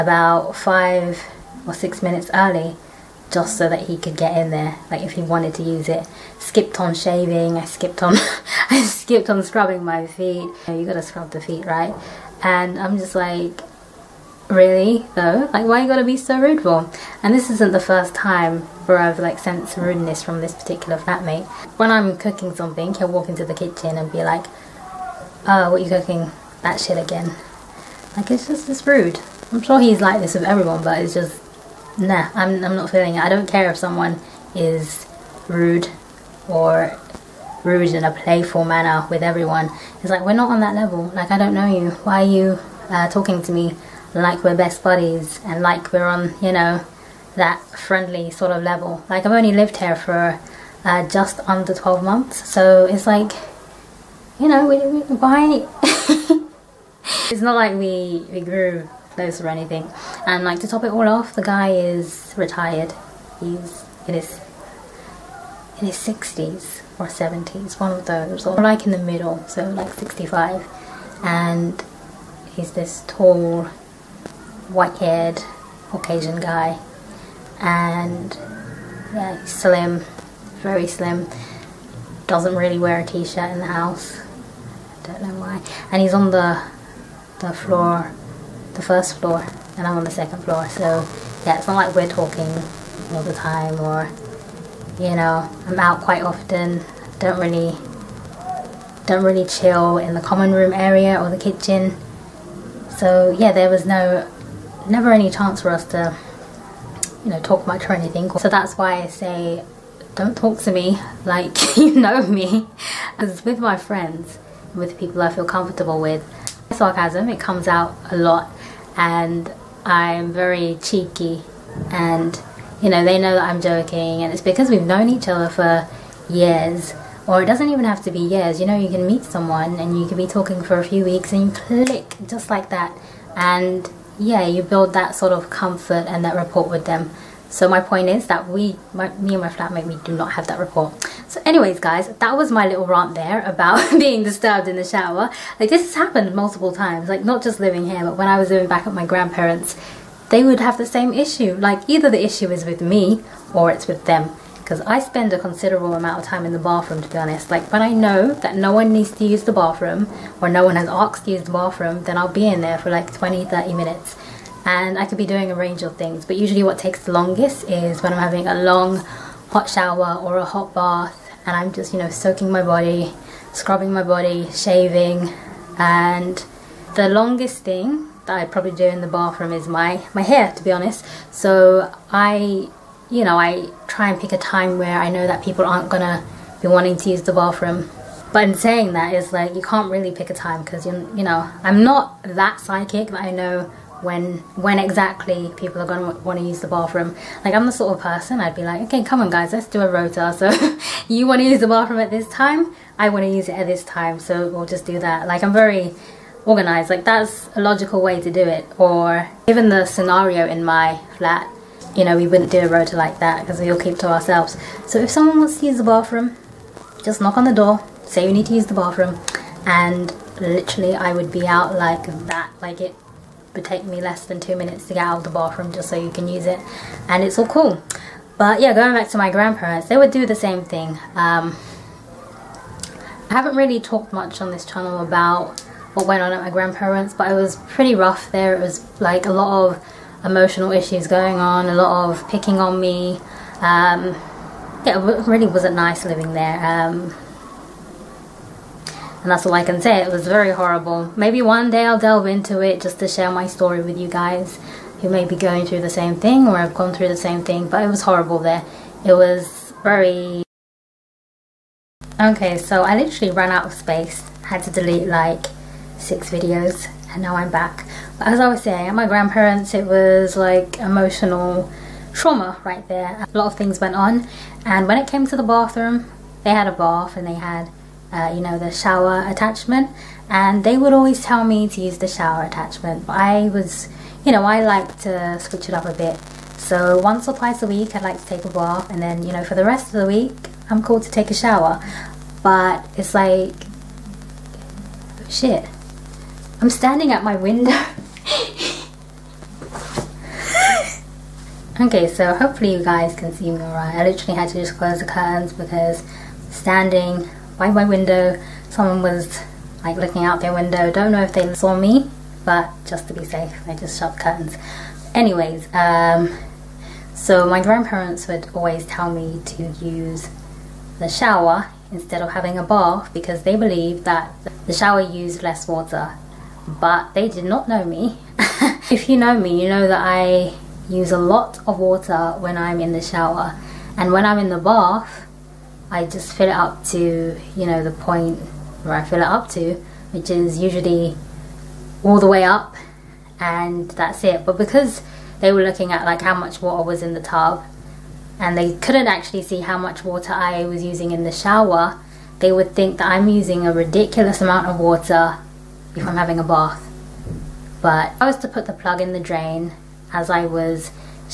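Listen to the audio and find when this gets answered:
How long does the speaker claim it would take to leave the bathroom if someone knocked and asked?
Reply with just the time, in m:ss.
3:43.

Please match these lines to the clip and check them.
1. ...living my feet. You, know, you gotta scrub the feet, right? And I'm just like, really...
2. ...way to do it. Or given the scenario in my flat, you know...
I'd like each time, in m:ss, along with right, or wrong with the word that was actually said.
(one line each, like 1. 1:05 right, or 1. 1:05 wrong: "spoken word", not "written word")
1. 0:09 wrong: "scrubbing", not "living"
2. 3:27 right.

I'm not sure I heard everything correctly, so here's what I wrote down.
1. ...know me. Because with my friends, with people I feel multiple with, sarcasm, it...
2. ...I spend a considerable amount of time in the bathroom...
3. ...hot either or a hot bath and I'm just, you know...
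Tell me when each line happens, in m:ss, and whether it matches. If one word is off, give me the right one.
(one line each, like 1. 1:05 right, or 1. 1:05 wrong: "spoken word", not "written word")
1. 1:51 wrong: "comfortable", not "multiple"
2. 2:34 right
3. 2:49 wrong: "shower", not "either".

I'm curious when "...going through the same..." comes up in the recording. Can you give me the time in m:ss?
4:15.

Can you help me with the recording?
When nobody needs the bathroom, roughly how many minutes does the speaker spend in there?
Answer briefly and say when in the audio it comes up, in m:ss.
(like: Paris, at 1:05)
20, 30 minutes, at 2:43.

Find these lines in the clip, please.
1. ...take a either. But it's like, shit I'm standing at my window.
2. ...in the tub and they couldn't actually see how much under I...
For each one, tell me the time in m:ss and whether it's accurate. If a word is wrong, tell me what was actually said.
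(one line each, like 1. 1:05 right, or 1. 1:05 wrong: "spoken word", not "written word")
1. 4:51 wrong: "shower", not "either"
2. 5:47 wrong: "water", not "under".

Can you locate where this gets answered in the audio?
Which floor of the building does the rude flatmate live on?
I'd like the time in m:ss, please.
1:28.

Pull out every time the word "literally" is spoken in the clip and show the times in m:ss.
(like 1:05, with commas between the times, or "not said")
3:40, 4:22, 5:04.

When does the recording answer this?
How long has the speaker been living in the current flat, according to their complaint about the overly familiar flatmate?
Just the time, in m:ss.
0:51.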